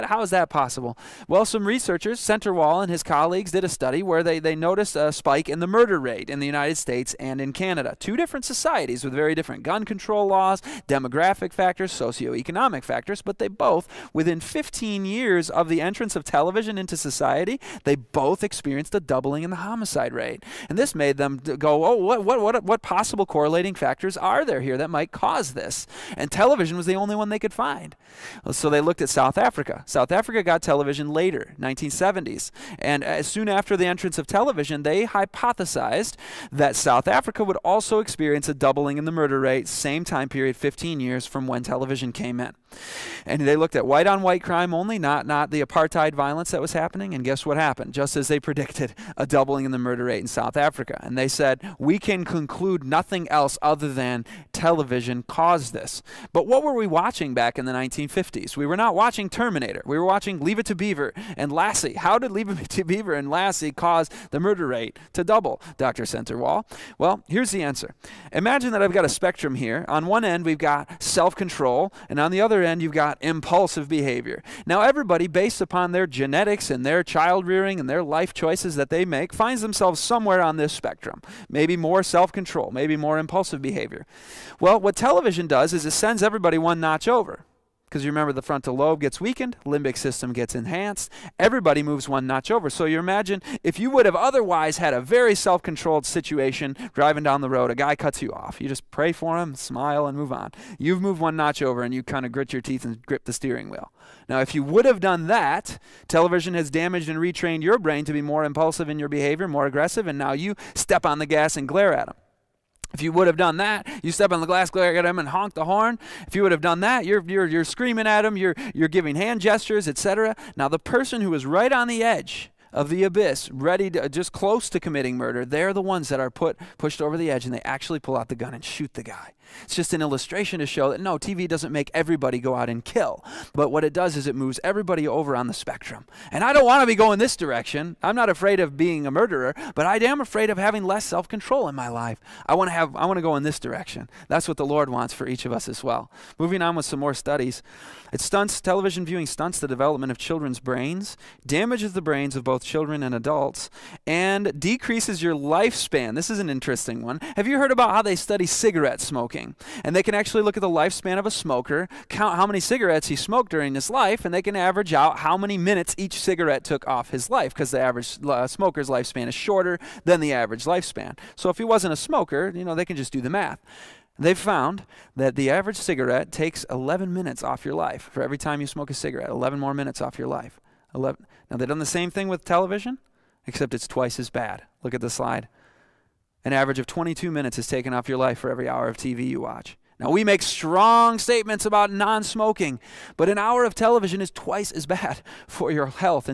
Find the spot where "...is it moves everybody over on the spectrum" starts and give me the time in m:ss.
2:14.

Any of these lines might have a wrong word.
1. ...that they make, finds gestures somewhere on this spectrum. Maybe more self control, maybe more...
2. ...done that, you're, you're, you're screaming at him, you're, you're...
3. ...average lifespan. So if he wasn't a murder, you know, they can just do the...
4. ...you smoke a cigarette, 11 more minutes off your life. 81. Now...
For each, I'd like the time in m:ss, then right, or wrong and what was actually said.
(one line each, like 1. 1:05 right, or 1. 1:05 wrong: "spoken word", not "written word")
1. 1:18 wrong: "themselves", not "gestures"
2. 1:56 right
3. 2:50 wrong: "smoker", not "murder"
4. 2:58 wrong: "11", not "81".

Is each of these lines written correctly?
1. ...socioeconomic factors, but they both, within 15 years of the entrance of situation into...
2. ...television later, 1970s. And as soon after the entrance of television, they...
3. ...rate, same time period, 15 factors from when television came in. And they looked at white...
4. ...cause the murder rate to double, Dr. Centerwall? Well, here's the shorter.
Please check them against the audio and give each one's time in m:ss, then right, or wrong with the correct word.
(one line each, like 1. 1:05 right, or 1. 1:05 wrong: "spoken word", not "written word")
1. 0:11 wrong: "television", not "situation"
2. 0:30 right
3. 0:39 wrong: "years", not "factors"
4. 1:03 wrong: "answer", not "shorter".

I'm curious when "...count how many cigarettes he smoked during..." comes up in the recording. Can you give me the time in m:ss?
2:42.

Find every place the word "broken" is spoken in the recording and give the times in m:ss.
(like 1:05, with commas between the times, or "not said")
not said.